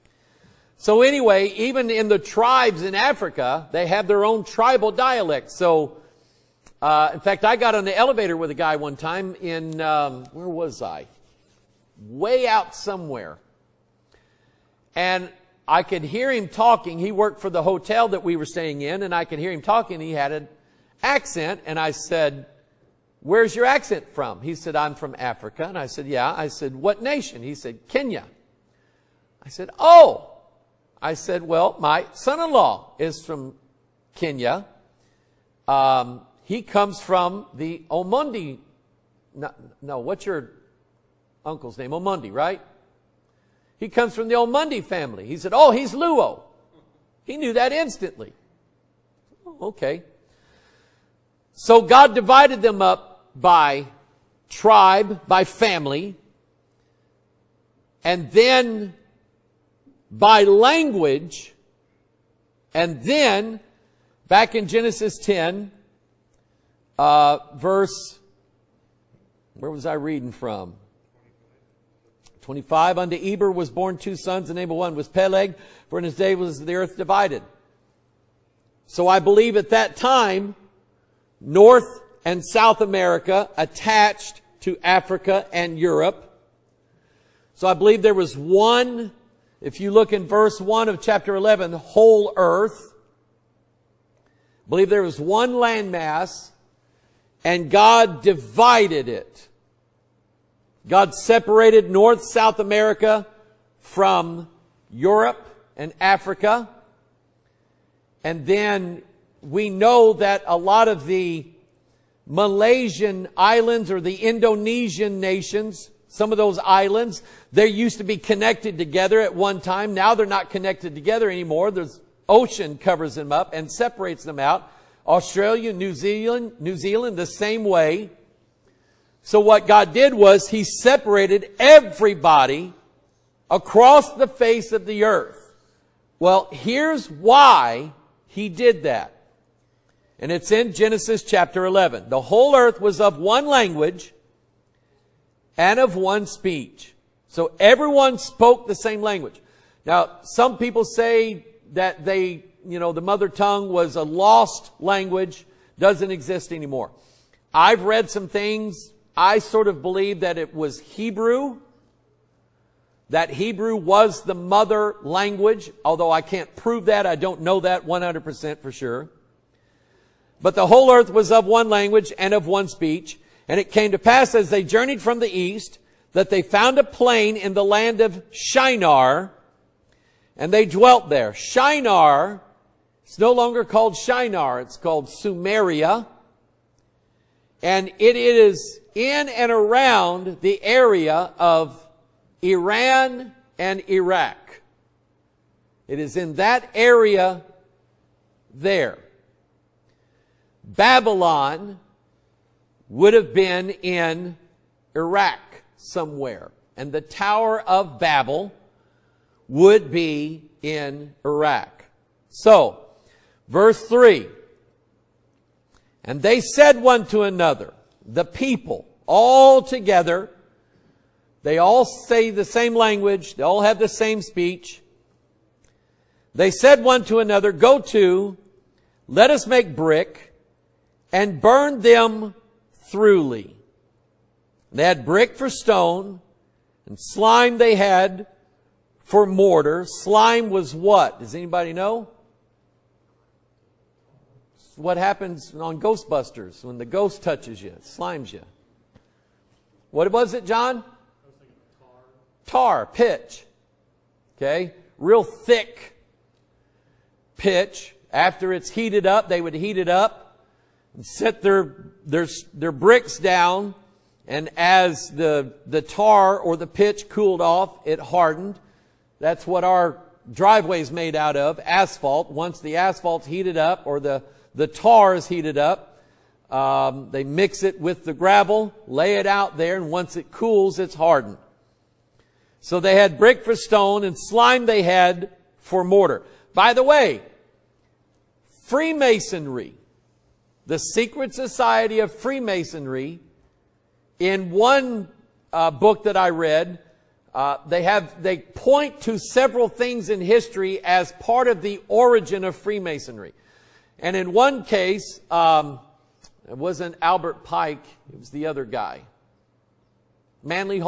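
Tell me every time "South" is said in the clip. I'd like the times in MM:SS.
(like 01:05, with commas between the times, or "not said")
01:22, 01:42.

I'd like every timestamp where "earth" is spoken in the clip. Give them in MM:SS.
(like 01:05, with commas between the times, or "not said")
01:16, 01:32, 02:15, 02:22, 02:50.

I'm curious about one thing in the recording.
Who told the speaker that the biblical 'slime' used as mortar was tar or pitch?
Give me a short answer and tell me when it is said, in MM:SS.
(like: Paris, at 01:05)
John, at 04:10.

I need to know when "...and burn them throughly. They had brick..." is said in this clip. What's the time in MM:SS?
03:51.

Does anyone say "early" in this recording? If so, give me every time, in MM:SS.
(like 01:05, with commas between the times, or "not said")
not said.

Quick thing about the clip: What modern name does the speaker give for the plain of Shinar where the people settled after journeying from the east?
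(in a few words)
Sumeria.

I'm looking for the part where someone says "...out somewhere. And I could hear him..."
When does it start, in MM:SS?
00:12.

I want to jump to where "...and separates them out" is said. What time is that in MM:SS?
02:03.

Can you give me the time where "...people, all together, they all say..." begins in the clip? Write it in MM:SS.
03:38.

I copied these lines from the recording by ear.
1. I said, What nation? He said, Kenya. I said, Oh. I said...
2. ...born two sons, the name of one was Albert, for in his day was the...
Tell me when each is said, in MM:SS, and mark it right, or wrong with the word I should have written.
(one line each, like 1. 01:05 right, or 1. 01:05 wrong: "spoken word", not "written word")
1. 00:26 right
2. 01:13 wrong: "Peleg", not "Albert".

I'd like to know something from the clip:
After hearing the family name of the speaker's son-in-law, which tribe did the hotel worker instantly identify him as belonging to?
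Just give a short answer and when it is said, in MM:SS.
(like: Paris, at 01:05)
Luo, at 00:45.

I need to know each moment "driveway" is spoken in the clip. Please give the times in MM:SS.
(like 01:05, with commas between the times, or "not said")
04:30.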